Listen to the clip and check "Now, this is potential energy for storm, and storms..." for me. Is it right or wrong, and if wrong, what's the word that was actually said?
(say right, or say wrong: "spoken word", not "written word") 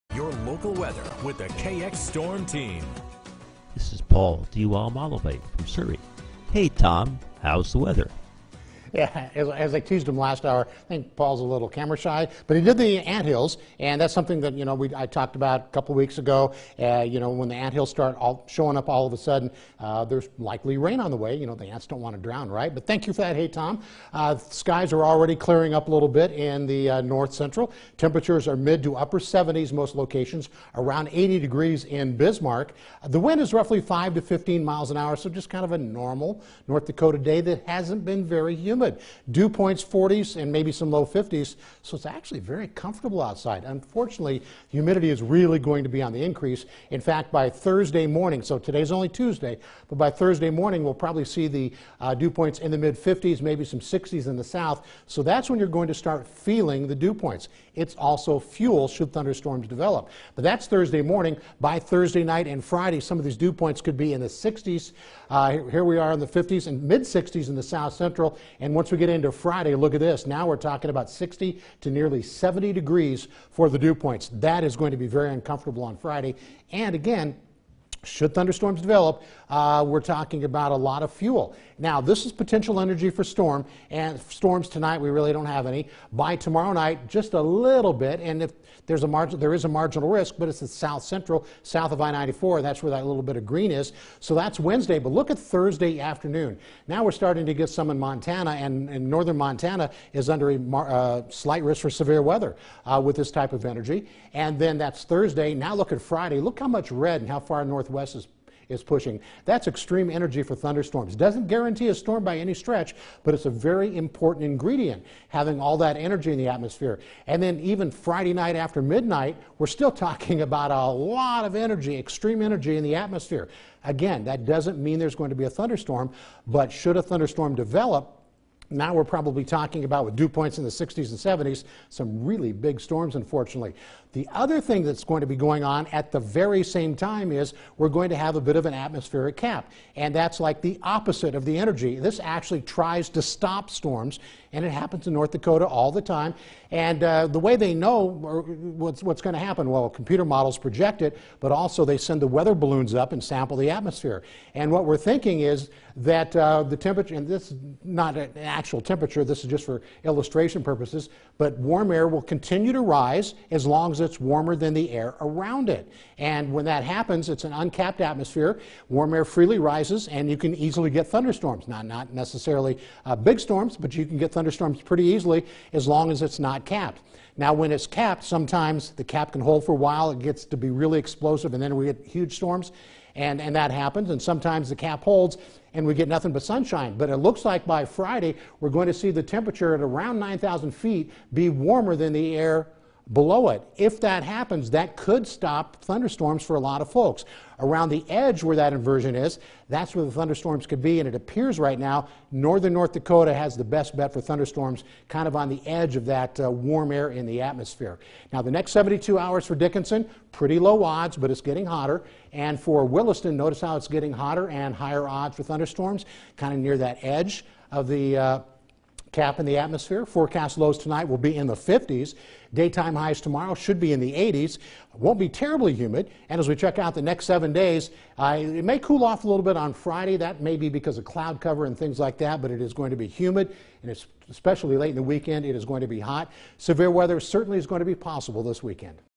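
right.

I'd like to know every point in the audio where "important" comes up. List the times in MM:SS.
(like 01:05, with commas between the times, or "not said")
01:53.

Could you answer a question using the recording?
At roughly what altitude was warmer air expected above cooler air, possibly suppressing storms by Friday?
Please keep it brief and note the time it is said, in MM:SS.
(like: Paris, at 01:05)
9,000 feet, at 03:10.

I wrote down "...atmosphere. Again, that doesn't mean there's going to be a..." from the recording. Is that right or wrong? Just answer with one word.
right.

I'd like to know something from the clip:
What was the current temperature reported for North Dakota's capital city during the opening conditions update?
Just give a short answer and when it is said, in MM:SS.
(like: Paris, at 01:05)
around 80 degrees, at 00:30.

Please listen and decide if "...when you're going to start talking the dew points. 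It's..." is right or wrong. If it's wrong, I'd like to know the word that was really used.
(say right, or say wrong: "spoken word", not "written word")
wrong: "feeling", not "talking".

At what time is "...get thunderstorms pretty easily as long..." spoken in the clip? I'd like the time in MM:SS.
02:54.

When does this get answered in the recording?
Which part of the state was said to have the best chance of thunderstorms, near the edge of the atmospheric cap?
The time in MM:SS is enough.
03:22.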